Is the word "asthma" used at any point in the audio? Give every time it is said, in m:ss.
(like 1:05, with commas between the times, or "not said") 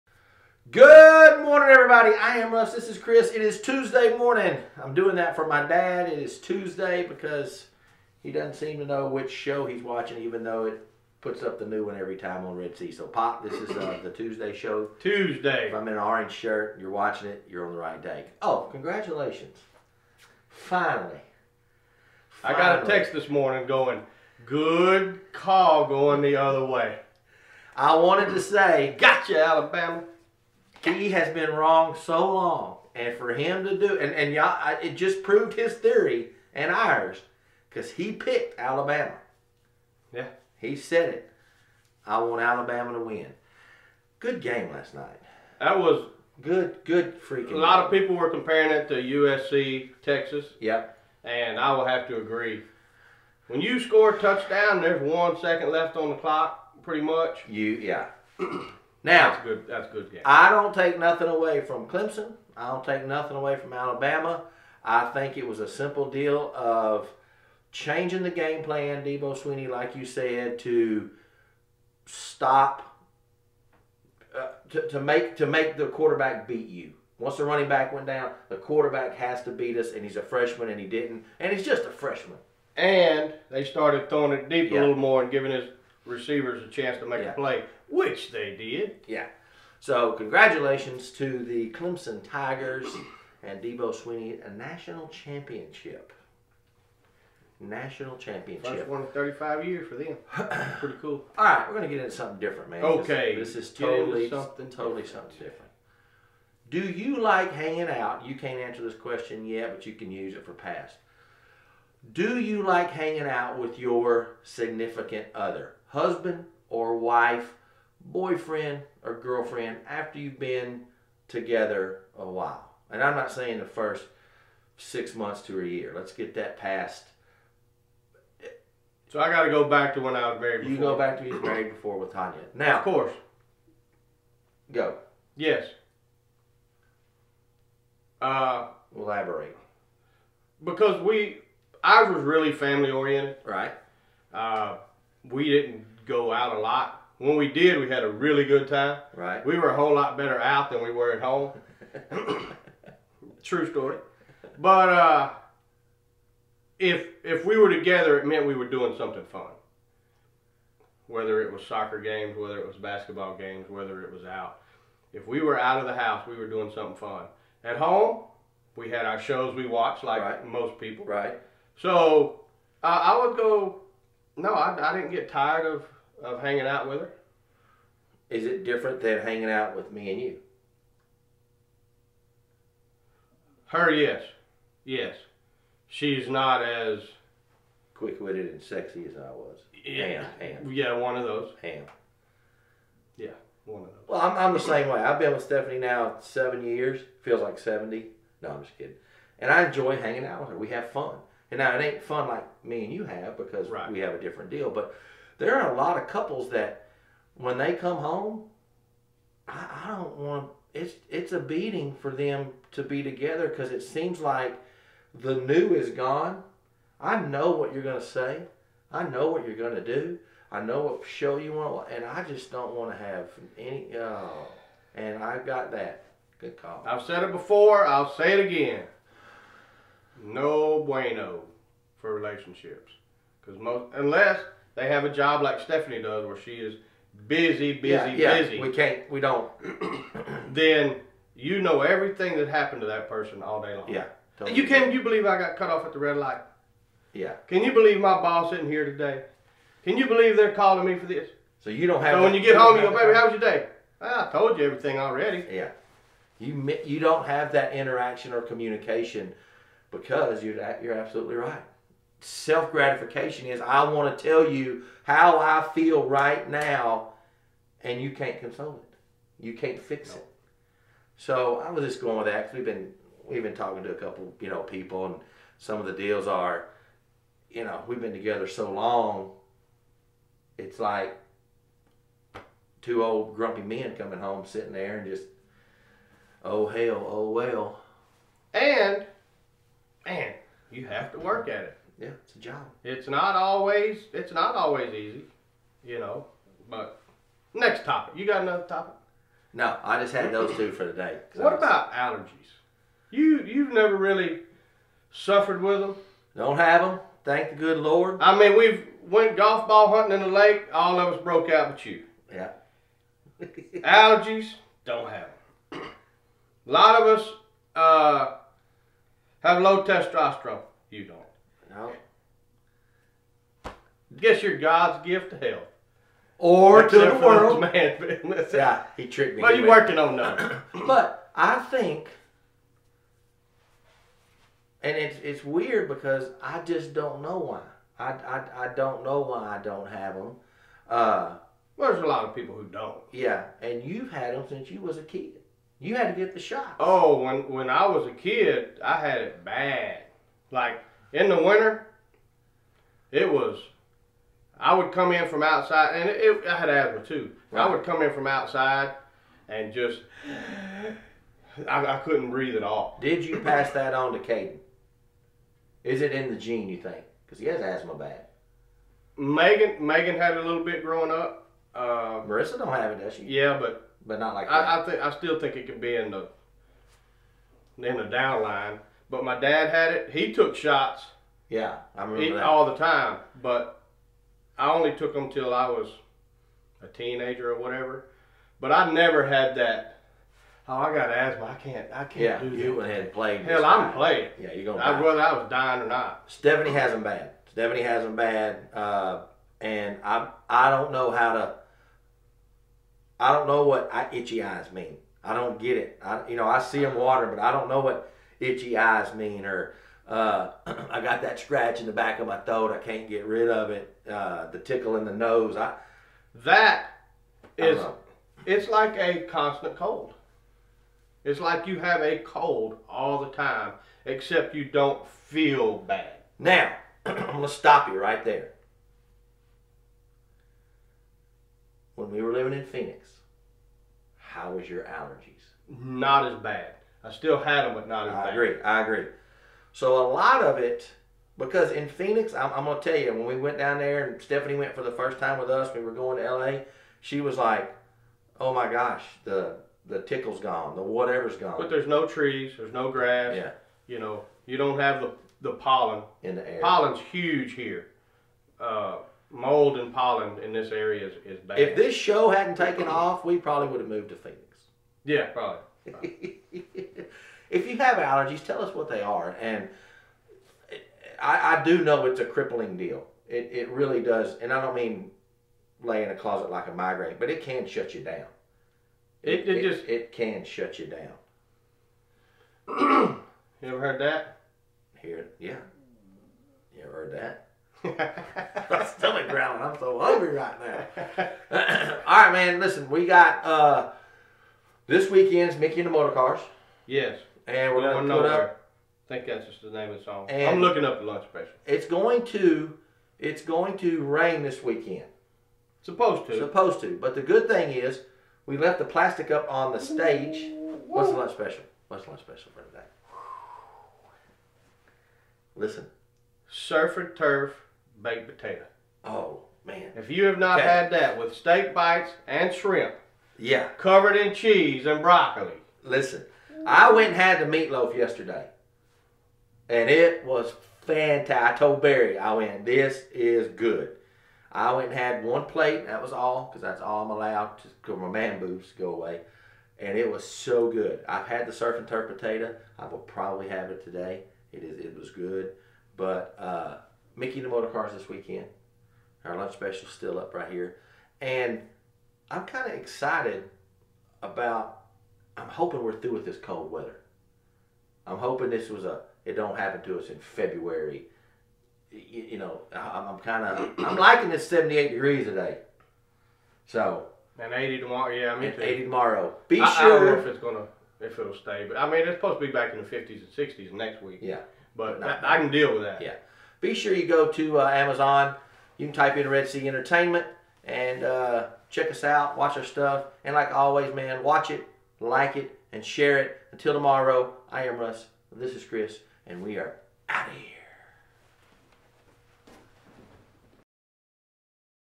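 5:56, 6:07, 6:31.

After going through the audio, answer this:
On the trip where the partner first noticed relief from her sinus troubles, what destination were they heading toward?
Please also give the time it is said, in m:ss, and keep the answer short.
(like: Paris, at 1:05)
LA, at 7:26.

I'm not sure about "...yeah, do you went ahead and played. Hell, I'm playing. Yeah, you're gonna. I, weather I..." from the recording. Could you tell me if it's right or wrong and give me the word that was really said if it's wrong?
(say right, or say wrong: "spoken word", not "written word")
wrong: "whether", not "weather".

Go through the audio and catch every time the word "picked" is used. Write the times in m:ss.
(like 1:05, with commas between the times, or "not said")
0:38.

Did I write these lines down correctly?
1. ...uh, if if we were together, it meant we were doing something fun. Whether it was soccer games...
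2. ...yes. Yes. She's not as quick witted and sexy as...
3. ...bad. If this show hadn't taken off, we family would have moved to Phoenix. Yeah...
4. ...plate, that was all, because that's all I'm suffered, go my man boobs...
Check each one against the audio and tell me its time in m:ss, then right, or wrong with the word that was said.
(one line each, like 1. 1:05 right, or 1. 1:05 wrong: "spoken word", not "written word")
1. 2:34 right
2. 3:03 right
3. 7:41 wrong: "probably", not "family"
4. 8:55 wrong: "allowed", not "suffered".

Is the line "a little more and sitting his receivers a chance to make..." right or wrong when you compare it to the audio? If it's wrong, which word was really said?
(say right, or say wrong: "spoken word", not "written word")
wrong: "giving", not "sitting".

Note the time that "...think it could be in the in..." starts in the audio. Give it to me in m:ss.
6:15.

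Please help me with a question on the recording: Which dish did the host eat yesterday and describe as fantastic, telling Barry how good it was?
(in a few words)
Meatloaf.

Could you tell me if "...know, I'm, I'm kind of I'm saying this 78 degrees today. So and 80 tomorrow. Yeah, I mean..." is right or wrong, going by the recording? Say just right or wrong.
wrong.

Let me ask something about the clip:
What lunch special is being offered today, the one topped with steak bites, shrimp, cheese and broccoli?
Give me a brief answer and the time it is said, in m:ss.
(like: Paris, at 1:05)
Surf and turf baked potato, at 8:36.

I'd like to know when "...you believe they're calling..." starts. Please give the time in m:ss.
4:09.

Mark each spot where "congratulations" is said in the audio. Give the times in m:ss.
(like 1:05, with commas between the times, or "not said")
0:18, 1:30.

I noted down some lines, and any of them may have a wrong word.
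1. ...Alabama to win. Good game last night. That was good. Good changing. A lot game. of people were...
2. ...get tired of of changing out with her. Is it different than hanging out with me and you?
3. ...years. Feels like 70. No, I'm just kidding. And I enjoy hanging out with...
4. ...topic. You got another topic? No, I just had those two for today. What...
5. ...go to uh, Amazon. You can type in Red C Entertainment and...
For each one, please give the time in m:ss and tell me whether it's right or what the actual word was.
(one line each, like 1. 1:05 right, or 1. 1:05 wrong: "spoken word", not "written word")
1. 0:42 wrong: "freaking", not "changing"
2. 2:55 wrong: "hanging", not "changing"
3. 3:16 right
4. 4:57 right
5. 9:37 right.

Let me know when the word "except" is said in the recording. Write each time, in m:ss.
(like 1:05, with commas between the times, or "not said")
5:26, 7:04.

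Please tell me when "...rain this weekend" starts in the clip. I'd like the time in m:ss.
8:24.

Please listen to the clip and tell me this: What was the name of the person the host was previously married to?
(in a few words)
Tanya.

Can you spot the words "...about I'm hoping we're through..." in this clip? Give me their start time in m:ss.
9:14.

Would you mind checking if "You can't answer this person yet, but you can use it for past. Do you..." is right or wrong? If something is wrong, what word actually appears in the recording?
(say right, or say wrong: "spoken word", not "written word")
wrong: "question", not "person".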